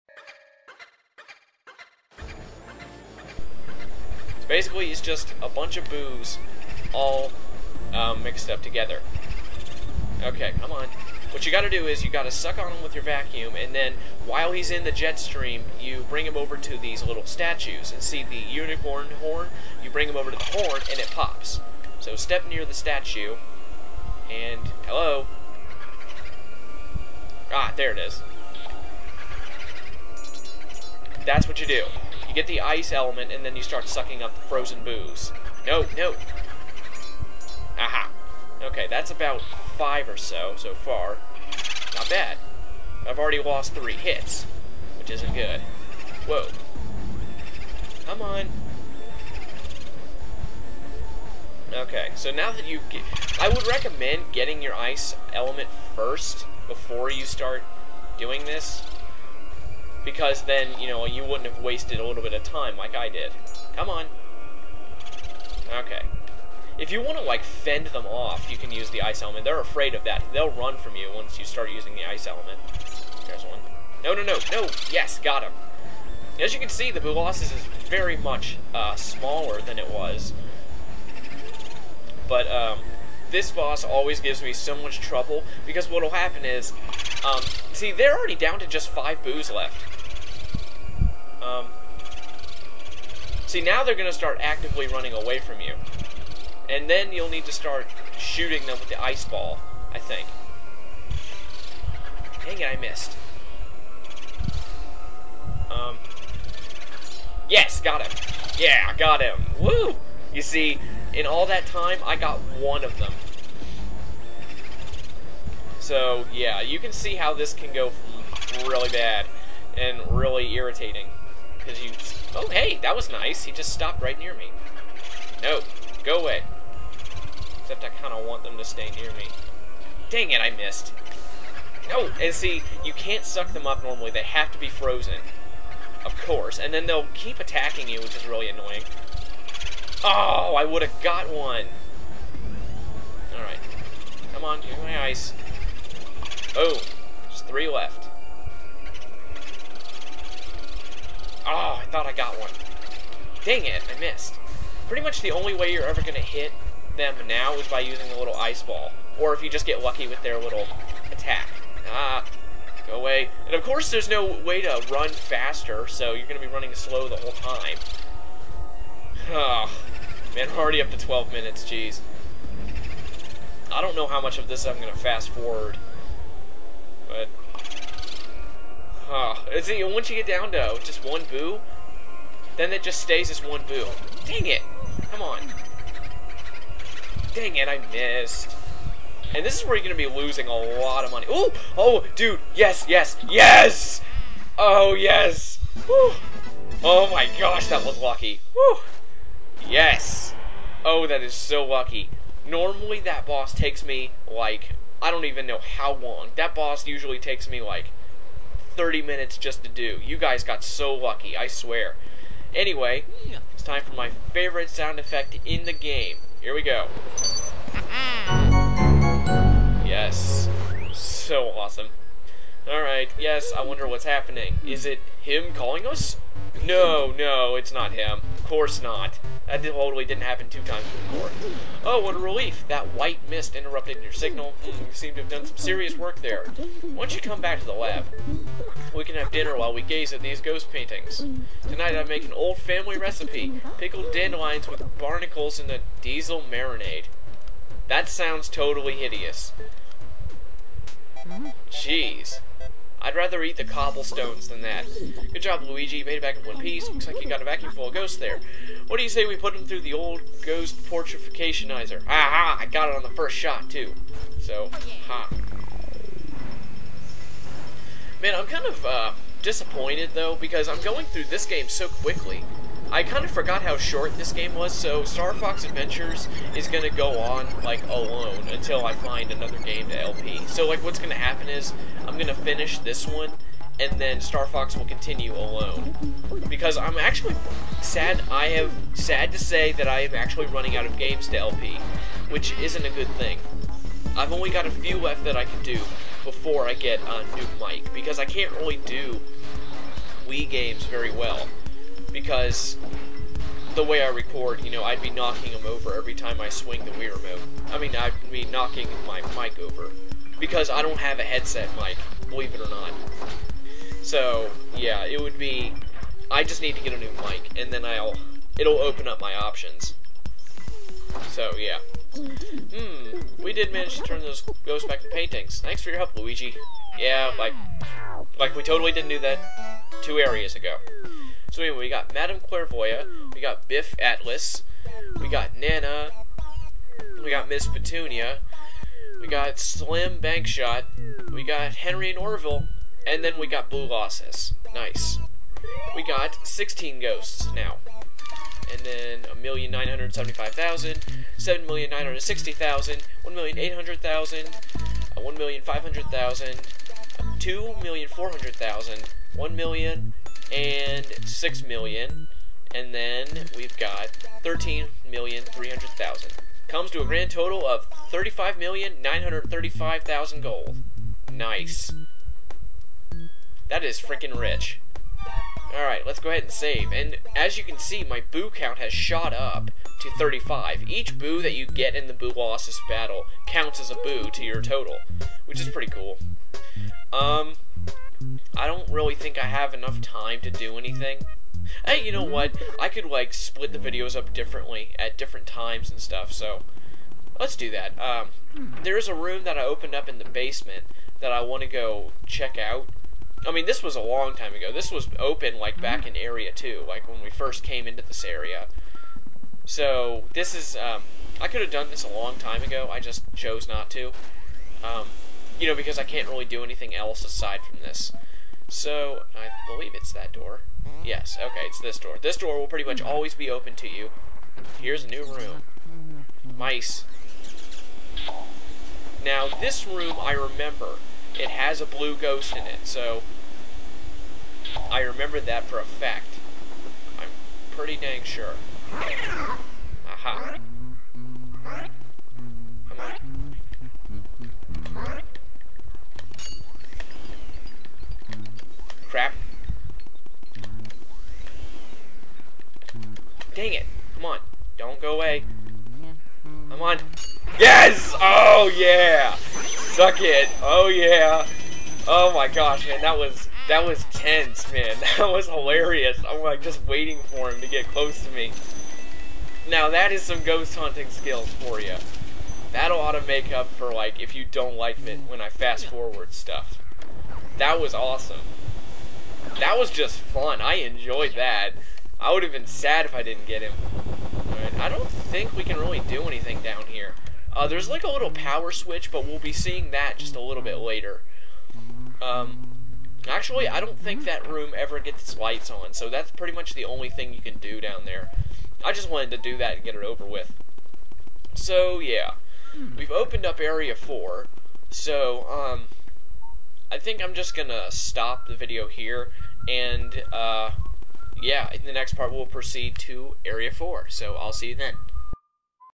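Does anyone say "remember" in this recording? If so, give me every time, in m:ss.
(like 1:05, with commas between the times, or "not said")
7:10, 7:15.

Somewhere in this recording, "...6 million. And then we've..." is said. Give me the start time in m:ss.
6:01.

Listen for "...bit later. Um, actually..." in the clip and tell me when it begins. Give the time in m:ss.
8:10.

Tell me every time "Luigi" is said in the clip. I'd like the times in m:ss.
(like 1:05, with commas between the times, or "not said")
4:15, 5:26.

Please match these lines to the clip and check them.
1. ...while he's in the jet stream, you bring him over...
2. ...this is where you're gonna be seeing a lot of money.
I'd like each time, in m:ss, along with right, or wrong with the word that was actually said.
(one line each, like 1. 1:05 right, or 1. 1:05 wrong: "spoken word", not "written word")
1. 0:14 right
2. 3:09 wrong: "losing", not "seeing".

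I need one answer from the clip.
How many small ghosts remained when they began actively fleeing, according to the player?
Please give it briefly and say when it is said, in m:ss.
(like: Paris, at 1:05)
5, at 1:28.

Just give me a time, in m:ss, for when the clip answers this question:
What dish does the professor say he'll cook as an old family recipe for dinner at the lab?
4:03.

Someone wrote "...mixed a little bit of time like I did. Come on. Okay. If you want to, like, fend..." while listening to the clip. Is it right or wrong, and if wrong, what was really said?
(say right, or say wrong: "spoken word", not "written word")
wrong: "wasted", not "mixed".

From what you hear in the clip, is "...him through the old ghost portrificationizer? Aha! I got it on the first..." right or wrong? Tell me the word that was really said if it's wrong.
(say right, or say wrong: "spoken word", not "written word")
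right.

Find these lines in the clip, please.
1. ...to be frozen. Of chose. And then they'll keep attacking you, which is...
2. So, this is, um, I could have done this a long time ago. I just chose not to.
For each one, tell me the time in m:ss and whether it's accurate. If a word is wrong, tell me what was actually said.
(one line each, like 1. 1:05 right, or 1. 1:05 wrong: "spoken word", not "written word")
1. 2:14 wrong: "course", not "chose"
2. 6:49 right.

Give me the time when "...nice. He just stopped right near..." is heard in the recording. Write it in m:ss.
2:03.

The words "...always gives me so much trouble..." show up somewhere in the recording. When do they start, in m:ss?
1:23.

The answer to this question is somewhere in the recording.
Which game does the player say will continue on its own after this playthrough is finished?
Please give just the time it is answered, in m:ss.
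4:35.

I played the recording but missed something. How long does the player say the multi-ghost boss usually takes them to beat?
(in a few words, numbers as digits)
30 minutes.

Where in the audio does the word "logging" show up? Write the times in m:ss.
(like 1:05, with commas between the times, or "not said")
not said.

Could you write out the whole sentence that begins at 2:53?
I don't know how much of this I'm going to fast forward.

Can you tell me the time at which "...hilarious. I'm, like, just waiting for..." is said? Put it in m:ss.
7:45.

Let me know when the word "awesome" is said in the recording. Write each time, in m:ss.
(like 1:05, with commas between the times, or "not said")
3:41, 7:57.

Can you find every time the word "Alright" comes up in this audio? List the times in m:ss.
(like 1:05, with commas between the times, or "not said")
2:23, 3:42, 6:15.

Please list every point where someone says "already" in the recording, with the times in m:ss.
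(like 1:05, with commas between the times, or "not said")
0:43, 1:28, 2:50.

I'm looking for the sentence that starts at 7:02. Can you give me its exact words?
This door will pretty much always be open to you.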